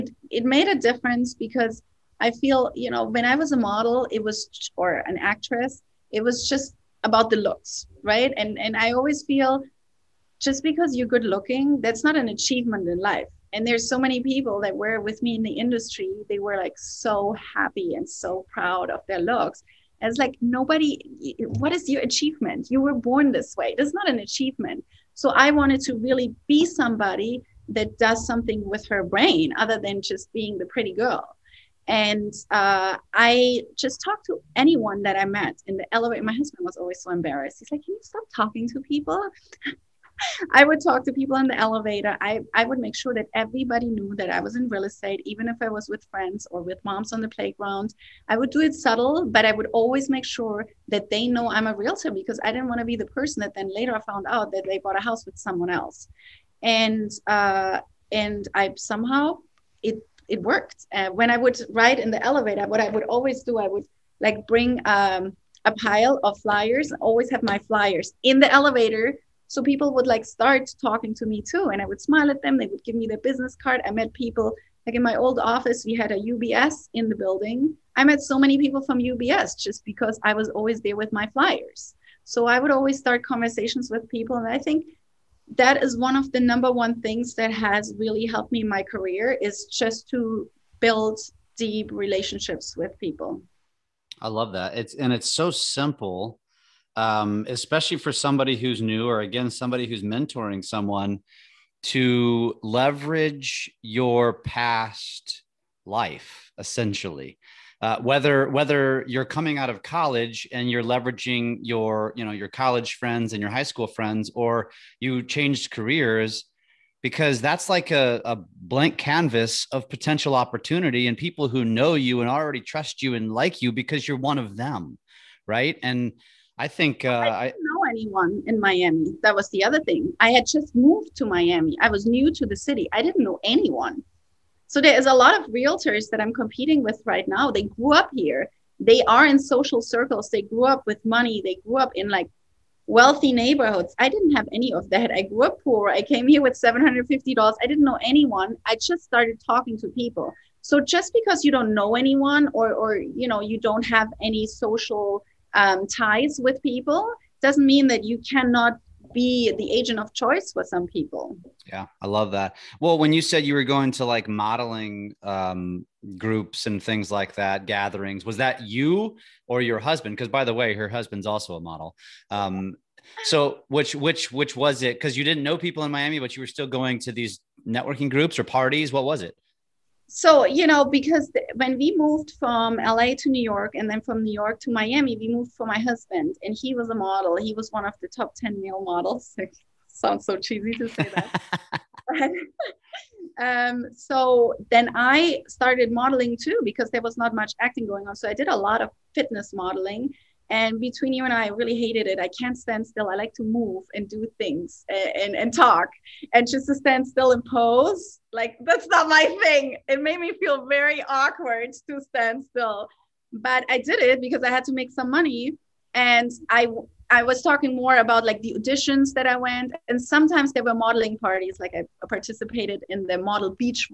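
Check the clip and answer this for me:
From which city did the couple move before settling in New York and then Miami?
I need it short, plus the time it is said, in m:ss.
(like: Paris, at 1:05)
LA, at 3:02.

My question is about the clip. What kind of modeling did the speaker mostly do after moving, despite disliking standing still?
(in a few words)
fitness modeling.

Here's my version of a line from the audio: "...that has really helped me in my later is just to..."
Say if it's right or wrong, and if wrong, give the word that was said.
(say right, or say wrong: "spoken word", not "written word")
wrong: "career", not "later".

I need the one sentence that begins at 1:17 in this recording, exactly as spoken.
I met so many people from UBS just because I was always there with my flyers.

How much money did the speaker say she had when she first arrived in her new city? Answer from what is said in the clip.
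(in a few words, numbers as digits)
$750.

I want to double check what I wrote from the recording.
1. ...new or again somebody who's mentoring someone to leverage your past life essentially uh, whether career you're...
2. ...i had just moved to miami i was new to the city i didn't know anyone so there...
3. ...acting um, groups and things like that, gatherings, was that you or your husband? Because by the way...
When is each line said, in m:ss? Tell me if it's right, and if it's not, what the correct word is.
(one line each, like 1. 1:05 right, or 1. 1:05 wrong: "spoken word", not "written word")
1. 1:38 wrong: "whether", not "career"
2. 2:10 right
3. 2:44 wrong: "modeling", not "acting".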